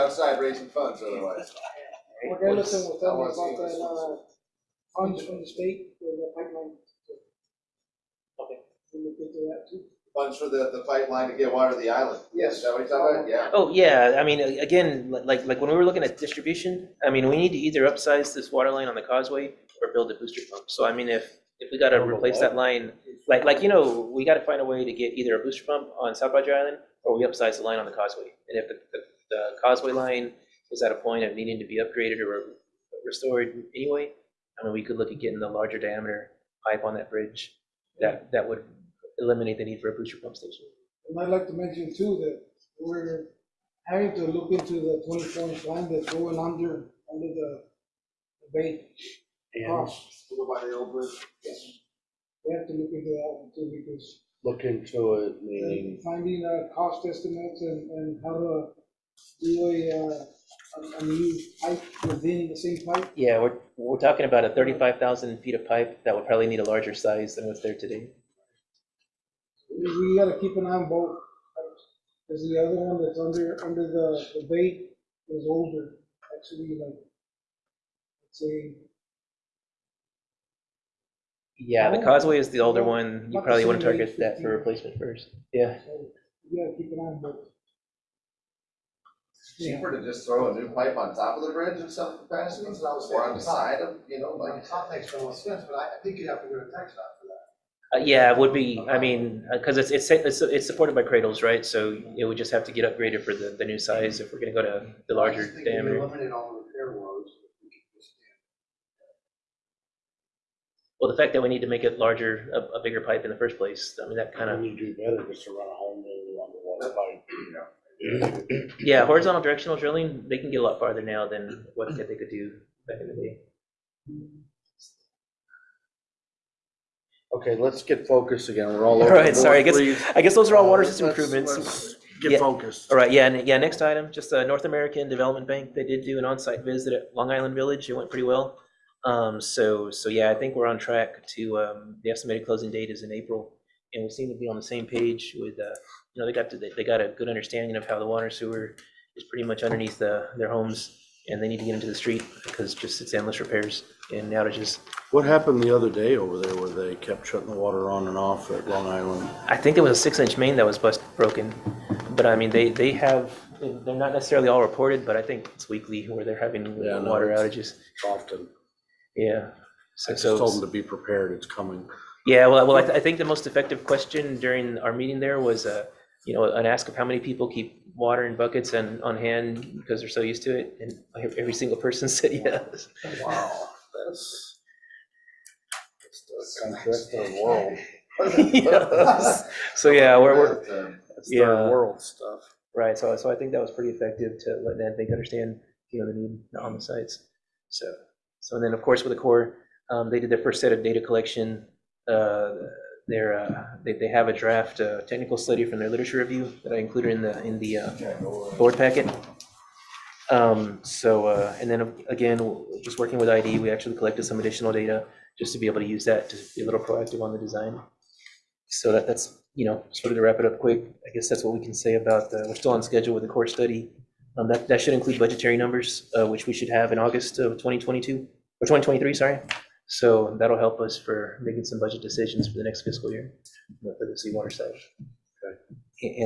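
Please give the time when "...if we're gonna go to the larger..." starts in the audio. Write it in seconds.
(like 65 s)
104 s.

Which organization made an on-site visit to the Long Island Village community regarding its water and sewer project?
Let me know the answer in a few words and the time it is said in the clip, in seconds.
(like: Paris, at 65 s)
North American Development Bank, at 134 s.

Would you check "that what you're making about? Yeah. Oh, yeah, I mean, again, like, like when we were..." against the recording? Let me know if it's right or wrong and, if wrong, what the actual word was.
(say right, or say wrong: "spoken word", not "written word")
wrong: "talking", not "making".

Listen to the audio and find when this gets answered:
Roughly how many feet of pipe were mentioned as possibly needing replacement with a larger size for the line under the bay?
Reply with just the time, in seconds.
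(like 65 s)
64 s.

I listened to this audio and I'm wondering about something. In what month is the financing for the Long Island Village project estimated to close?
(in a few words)
April.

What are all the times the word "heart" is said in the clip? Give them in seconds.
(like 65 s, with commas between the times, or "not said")
not said.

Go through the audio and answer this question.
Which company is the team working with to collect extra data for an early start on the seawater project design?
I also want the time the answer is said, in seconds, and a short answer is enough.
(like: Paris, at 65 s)
IDE, at 213 s.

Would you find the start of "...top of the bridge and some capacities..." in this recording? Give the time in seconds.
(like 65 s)
91 s.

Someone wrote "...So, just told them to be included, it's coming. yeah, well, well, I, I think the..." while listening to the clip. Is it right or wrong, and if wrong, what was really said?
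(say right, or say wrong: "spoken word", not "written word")
wrong: "prepared", not "included".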